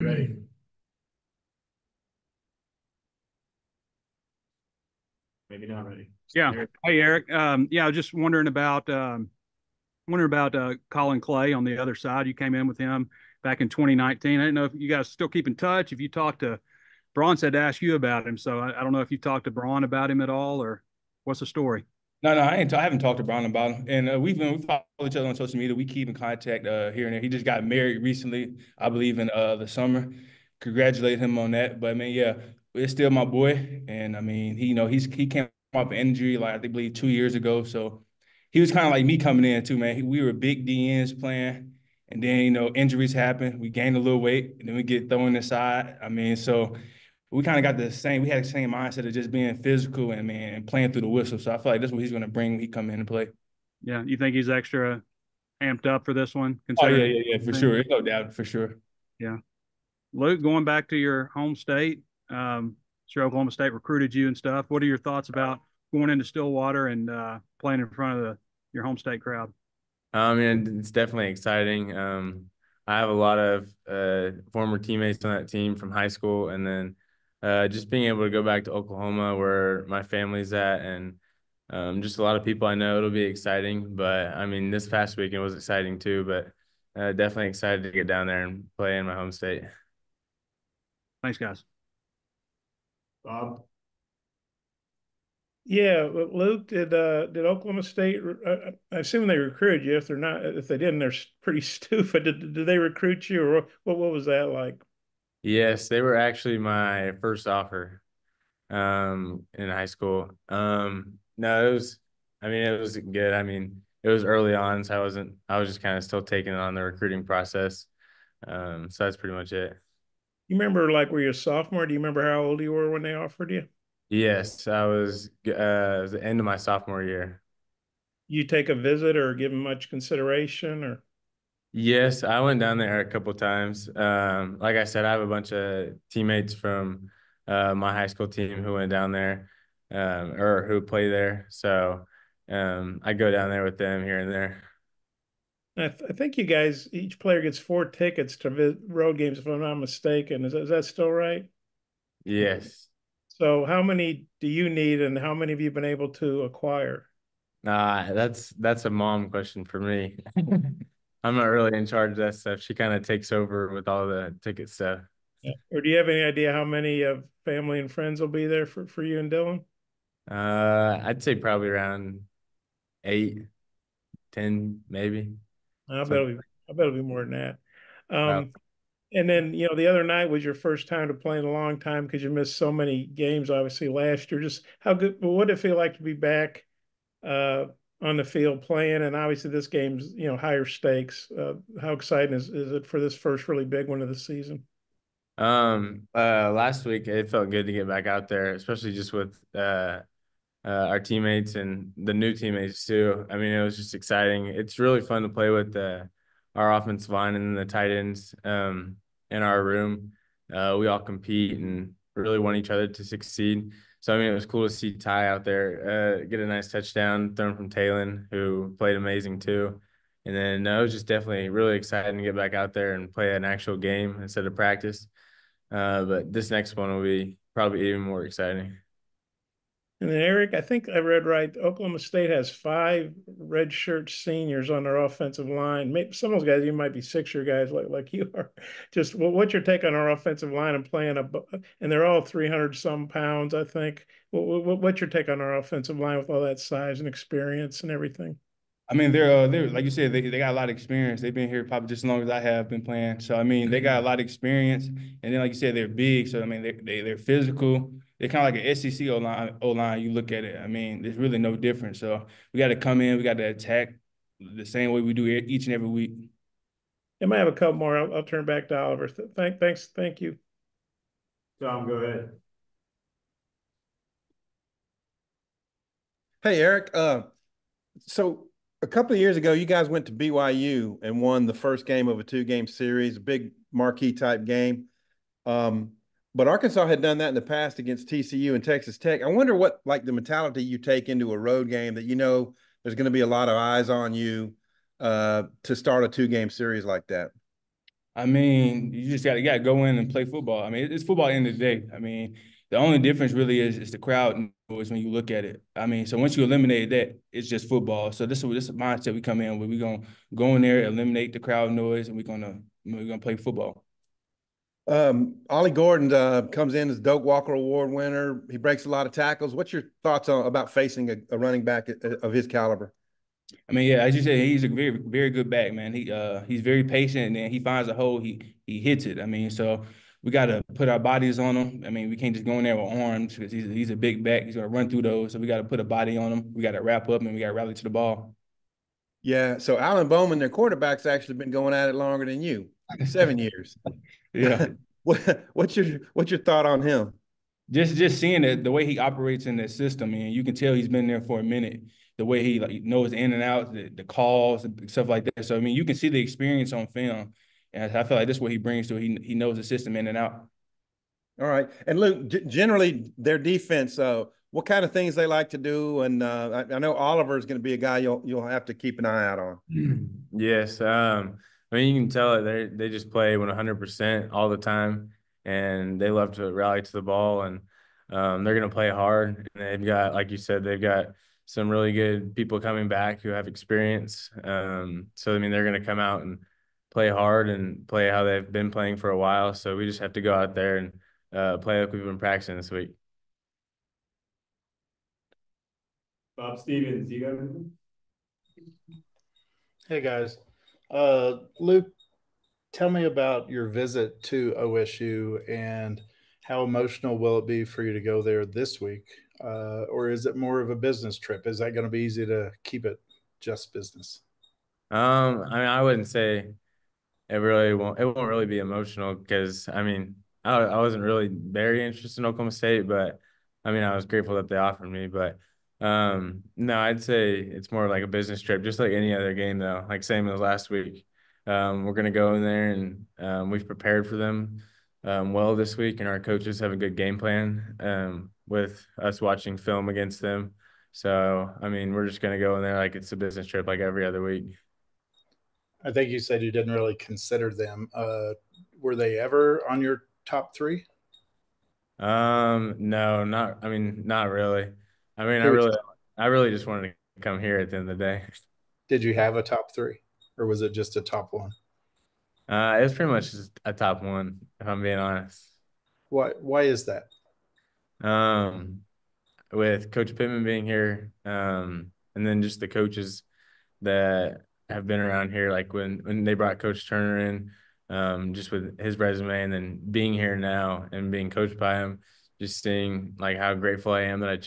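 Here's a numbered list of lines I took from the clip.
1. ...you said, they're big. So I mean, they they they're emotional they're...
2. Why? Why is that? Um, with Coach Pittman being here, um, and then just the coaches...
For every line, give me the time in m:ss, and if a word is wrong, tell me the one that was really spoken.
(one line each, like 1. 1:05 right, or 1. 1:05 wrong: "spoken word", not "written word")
1. 4:15 wrong: "physical", not "emotional"
2. 7:46 right.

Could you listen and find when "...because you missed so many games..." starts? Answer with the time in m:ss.
3:02.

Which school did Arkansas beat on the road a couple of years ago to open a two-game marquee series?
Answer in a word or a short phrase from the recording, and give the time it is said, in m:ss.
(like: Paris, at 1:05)
BYU, at 4:40.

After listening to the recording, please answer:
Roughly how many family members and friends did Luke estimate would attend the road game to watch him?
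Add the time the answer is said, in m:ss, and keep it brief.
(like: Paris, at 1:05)
8-10, at 2:53.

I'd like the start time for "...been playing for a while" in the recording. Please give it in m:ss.
6:28.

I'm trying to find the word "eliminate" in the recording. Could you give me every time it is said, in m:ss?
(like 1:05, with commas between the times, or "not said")
5:06, 5:10.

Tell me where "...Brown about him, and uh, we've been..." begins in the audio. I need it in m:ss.
0:23.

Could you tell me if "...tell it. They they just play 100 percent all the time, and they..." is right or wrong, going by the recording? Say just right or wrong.
right.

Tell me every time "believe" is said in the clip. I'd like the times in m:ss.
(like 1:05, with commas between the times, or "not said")
0:28, 0:36.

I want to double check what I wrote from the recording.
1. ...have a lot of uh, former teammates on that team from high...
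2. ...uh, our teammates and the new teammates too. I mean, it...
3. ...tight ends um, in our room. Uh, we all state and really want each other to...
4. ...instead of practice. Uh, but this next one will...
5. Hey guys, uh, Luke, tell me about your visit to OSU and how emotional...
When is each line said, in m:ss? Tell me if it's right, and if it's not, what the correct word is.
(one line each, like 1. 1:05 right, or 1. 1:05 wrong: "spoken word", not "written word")
1. 1:12 right
2. 3:20 right
3. 3:27 wrong: "compete", not "state"
4. 3:44 right
5. 6:39 right.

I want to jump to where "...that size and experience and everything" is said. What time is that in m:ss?
4:06.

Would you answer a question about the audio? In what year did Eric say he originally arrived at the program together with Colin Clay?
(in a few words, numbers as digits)
2019.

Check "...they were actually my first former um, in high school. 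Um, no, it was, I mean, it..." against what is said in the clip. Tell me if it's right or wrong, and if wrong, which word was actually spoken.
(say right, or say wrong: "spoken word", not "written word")
wrong: "offer", not "former".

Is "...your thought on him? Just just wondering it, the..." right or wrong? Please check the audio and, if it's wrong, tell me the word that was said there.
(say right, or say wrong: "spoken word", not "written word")
wrong: "seeing", not "wondering".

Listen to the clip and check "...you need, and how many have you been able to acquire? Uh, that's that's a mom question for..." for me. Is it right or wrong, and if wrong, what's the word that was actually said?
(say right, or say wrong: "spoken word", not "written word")
right.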